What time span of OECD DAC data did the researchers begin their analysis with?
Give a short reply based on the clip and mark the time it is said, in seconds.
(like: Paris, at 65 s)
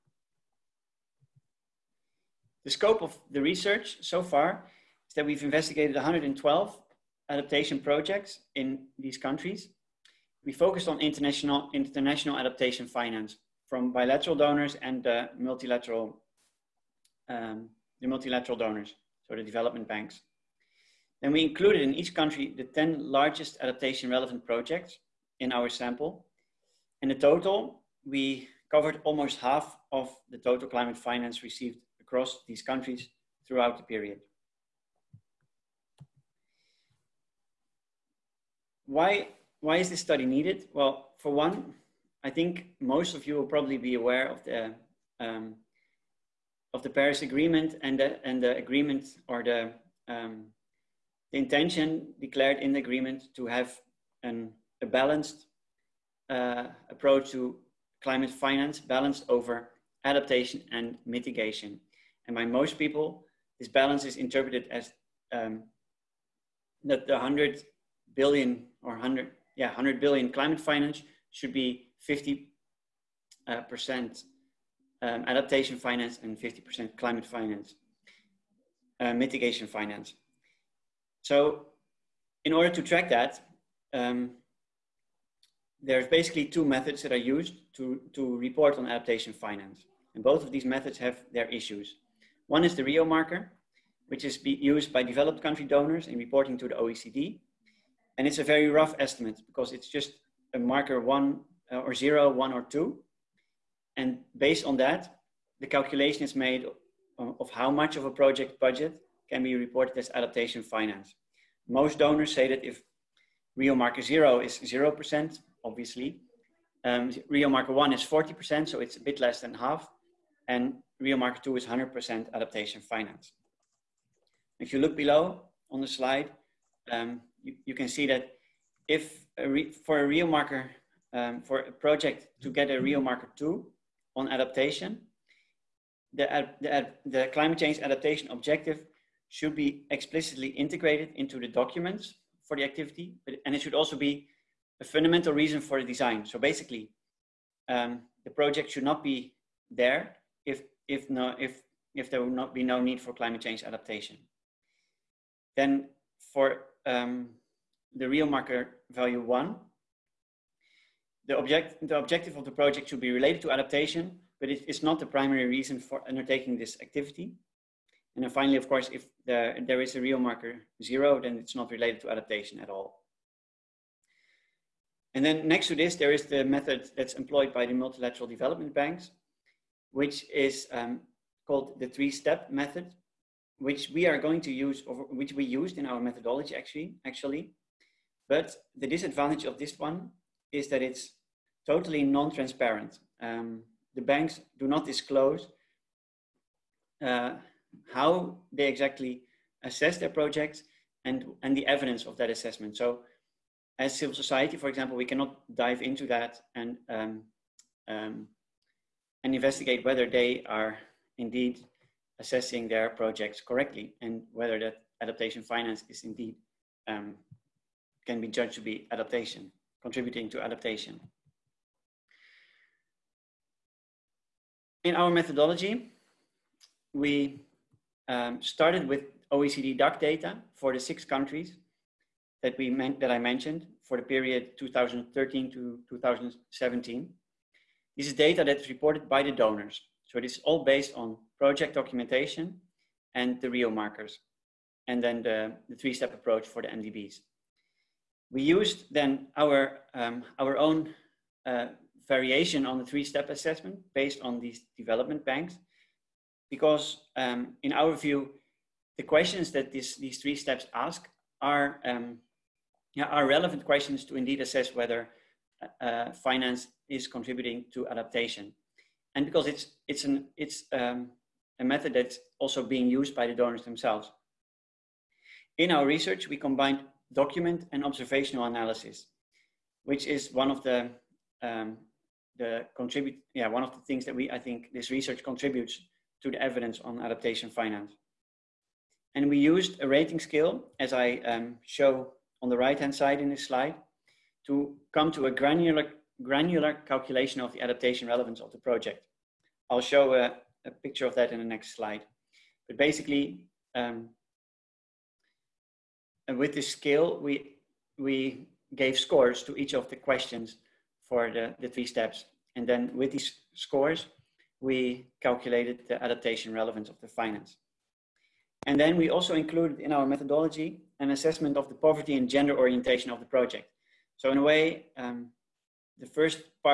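2013 to 2017, at 234 s.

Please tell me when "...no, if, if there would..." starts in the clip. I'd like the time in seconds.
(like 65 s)
151 s.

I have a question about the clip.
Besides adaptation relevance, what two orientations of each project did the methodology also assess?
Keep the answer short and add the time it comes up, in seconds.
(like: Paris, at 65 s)
poverty and gender, at 321 s.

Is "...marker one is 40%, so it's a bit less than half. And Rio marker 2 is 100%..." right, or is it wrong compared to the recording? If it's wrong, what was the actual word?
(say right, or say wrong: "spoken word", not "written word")
right.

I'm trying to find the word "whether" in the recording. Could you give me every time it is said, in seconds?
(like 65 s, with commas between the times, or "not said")
209 s, 214 s, 264 s.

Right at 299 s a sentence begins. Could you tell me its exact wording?
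I'll show a, a picture of that in the next slide.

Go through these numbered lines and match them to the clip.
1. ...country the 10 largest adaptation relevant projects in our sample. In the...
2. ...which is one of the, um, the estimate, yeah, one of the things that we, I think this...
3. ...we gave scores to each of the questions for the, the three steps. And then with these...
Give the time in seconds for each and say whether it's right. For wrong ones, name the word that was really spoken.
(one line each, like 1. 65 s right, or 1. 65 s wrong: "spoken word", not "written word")
1. 22 s right
2. 279 s wrong: "contribute", not "estimate"
3. 307 s right.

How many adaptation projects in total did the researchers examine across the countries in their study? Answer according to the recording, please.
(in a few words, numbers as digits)
112.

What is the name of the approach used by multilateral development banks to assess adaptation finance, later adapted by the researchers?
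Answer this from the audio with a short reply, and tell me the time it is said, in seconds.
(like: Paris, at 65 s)
three-step method, at 181 s.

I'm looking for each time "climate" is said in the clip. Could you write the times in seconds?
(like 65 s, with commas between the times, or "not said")
30 s, 58 s, 70 s, 76 s, 137 s, 153 s.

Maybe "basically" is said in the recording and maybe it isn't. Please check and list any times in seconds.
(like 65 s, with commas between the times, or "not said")
86 s, 146 s, 302 s.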